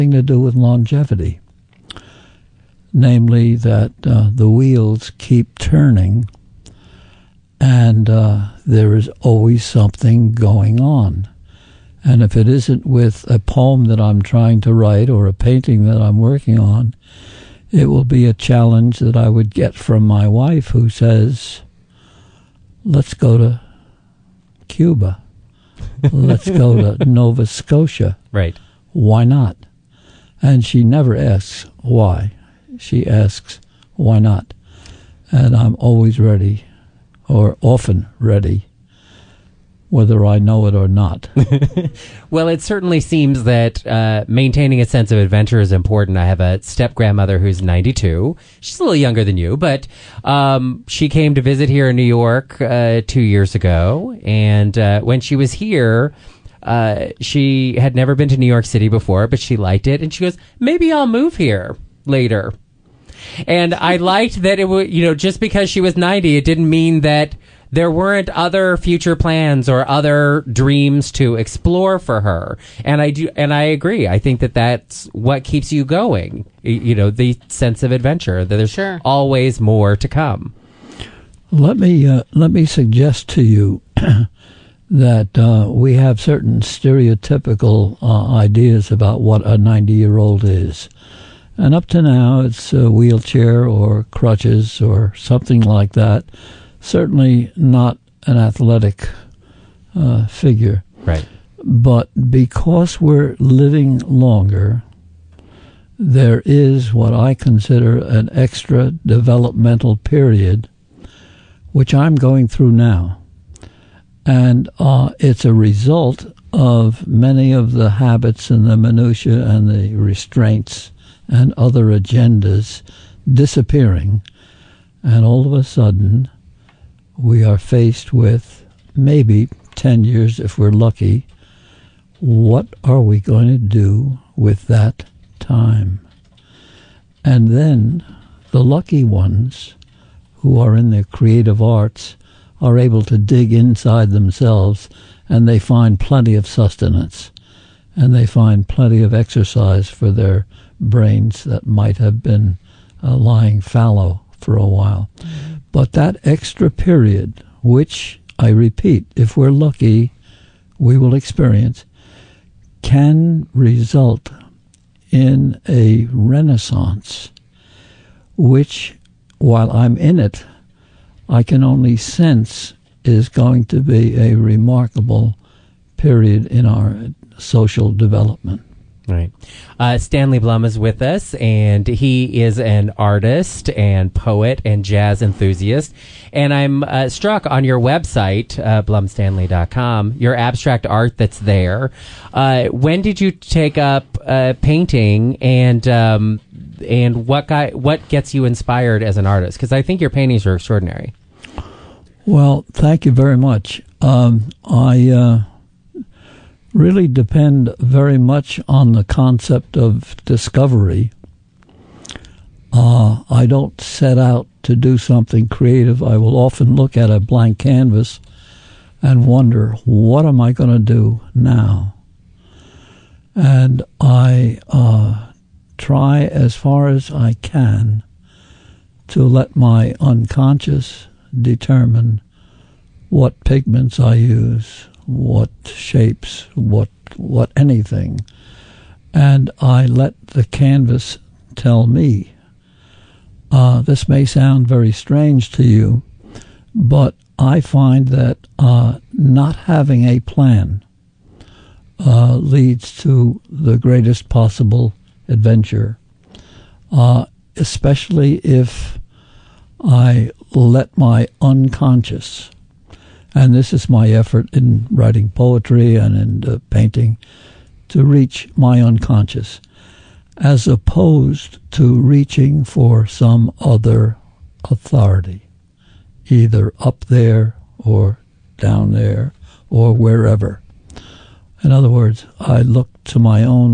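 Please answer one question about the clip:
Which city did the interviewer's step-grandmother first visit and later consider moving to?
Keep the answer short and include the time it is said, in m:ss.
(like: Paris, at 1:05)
New York City, at 0:58.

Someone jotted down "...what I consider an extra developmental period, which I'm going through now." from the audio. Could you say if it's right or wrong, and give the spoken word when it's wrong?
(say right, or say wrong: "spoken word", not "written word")
right.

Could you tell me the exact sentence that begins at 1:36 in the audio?
Certainly not an athletic uh, figure.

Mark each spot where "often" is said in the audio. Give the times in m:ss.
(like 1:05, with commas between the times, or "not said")
0:37, 3:36.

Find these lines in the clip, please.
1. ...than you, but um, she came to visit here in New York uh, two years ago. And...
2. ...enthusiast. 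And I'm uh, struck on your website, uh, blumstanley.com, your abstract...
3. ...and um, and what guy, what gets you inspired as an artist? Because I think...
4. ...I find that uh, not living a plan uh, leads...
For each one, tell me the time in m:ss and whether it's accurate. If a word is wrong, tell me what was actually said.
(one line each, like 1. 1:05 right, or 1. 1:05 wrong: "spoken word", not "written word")
1. 0:49 right
2. 3:05 right
3. 3:15 right
4. 4:07 wrong: "having", not "living".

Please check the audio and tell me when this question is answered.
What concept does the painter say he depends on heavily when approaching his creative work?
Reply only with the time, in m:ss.
3:30.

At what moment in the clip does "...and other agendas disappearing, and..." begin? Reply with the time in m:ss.
2:01.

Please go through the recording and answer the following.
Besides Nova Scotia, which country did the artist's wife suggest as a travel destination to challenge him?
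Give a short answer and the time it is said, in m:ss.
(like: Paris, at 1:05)
Cuba, at 0:24.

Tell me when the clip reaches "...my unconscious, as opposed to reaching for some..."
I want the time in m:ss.
4:28.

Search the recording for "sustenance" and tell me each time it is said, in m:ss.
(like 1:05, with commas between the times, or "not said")
2:26.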